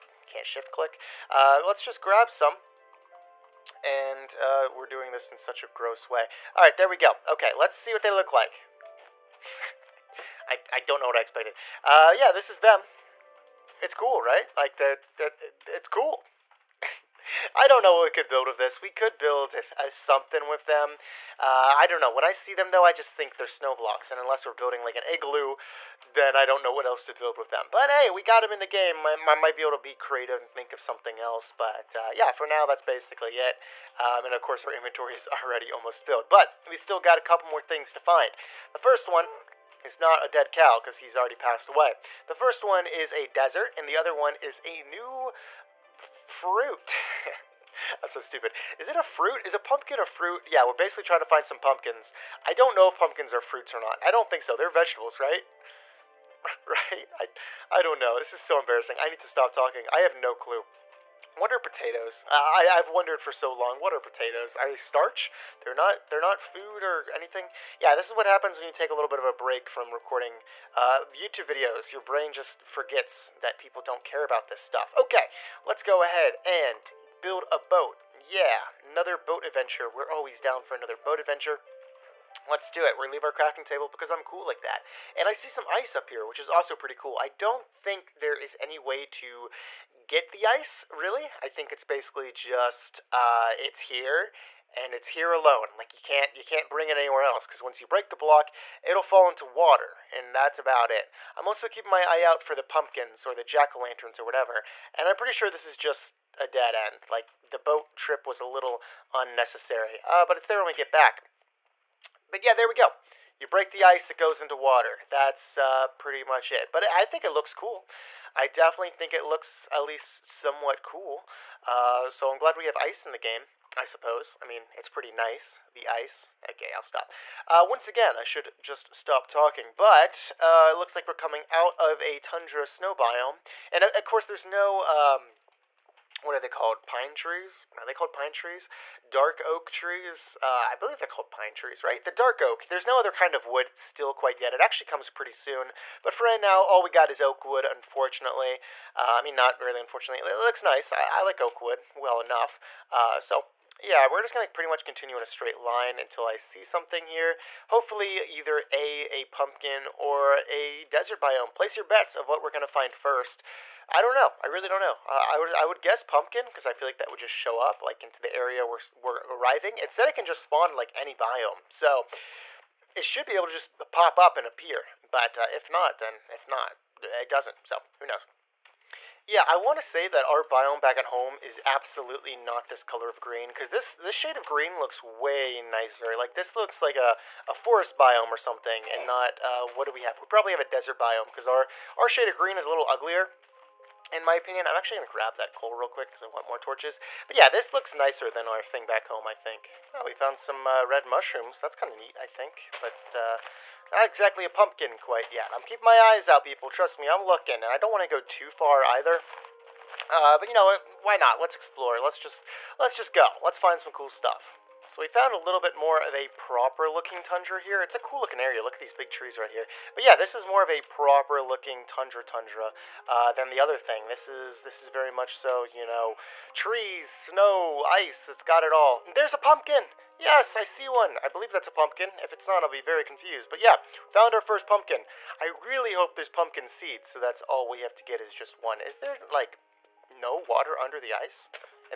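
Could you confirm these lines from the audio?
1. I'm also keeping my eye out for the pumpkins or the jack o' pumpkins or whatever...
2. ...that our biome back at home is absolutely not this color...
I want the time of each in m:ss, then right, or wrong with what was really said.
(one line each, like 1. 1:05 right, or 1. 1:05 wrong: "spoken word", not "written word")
1. 1:41 wrong: "lanterns", not "pumpkins"
2. 3:00 right.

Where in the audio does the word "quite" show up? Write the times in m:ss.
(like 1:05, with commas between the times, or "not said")
2:24, 3:24.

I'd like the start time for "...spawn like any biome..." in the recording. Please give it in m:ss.
2:50.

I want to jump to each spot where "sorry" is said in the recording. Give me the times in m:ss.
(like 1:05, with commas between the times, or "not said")
not said.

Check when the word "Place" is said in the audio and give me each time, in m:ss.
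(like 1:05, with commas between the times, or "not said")
2:41.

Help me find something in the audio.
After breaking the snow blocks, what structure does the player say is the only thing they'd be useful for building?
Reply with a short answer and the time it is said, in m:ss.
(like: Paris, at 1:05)
An igloo, at 0:24.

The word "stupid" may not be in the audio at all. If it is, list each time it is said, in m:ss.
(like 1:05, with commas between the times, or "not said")
0:48.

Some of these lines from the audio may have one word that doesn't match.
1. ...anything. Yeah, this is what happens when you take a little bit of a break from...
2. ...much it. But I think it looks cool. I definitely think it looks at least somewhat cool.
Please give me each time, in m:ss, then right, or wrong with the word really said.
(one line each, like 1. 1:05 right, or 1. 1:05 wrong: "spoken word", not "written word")
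1. 1:07 right
2. 1:56 right.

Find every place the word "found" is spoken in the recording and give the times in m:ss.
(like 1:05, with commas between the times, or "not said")
3:20, 3:35, 3:54.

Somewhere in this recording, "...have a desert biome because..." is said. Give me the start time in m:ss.
3:10.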